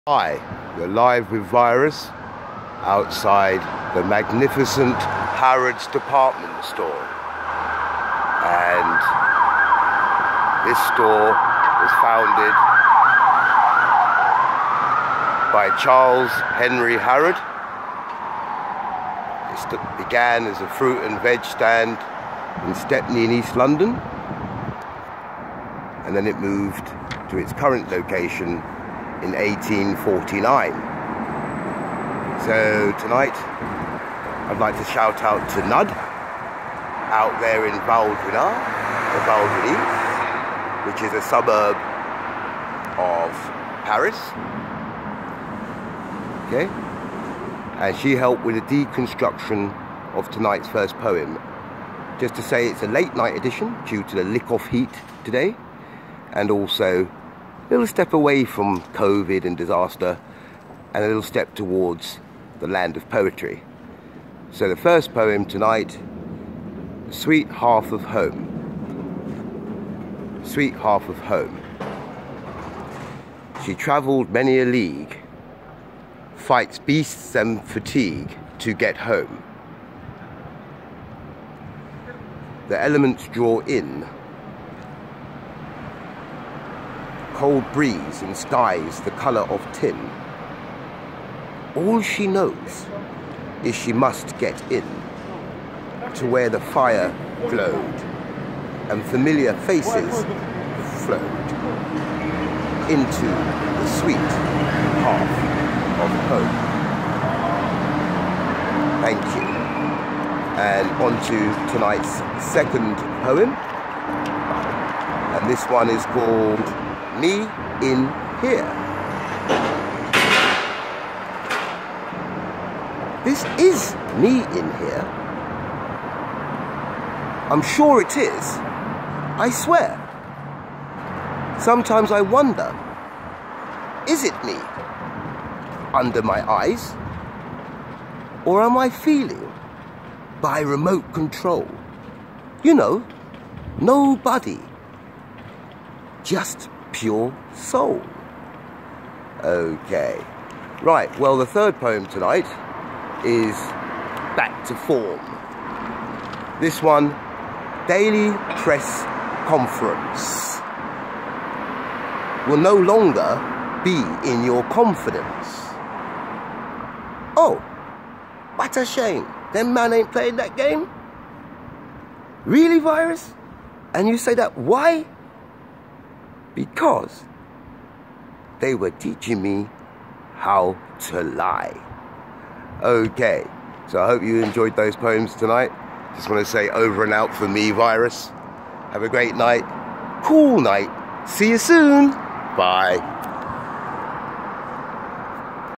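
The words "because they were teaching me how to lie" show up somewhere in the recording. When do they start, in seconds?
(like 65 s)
176 s.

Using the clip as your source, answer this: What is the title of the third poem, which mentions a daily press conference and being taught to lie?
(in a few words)
Back to Form.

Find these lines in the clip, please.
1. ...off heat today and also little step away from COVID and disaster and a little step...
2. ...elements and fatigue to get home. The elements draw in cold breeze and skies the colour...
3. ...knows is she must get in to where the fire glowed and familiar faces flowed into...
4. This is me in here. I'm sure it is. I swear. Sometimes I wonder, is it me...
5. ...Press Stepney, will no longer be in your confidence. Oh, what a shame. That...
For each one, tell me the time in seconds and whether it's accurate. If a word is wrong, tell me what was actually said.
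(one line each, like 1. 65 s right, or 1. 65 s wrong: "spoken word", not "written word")
1. 54 s right
2. 76 s wrong: "beasts", not "elements"
3. 92 s right
4. 123 s right
5. 158 s wrong: "Conference", not "Stepney".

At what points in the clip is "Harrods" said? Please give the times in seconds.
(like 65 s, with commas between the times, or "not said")
4 s, 16 s.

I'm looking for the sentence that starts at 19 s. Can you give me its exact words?
It began as a fruit and veg stand in Stepney in East London.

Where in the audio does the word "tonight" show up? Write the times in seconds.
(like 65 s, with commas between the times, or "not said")
32 s, 50 s, 65 s, 111 s, 152 s, 185 s.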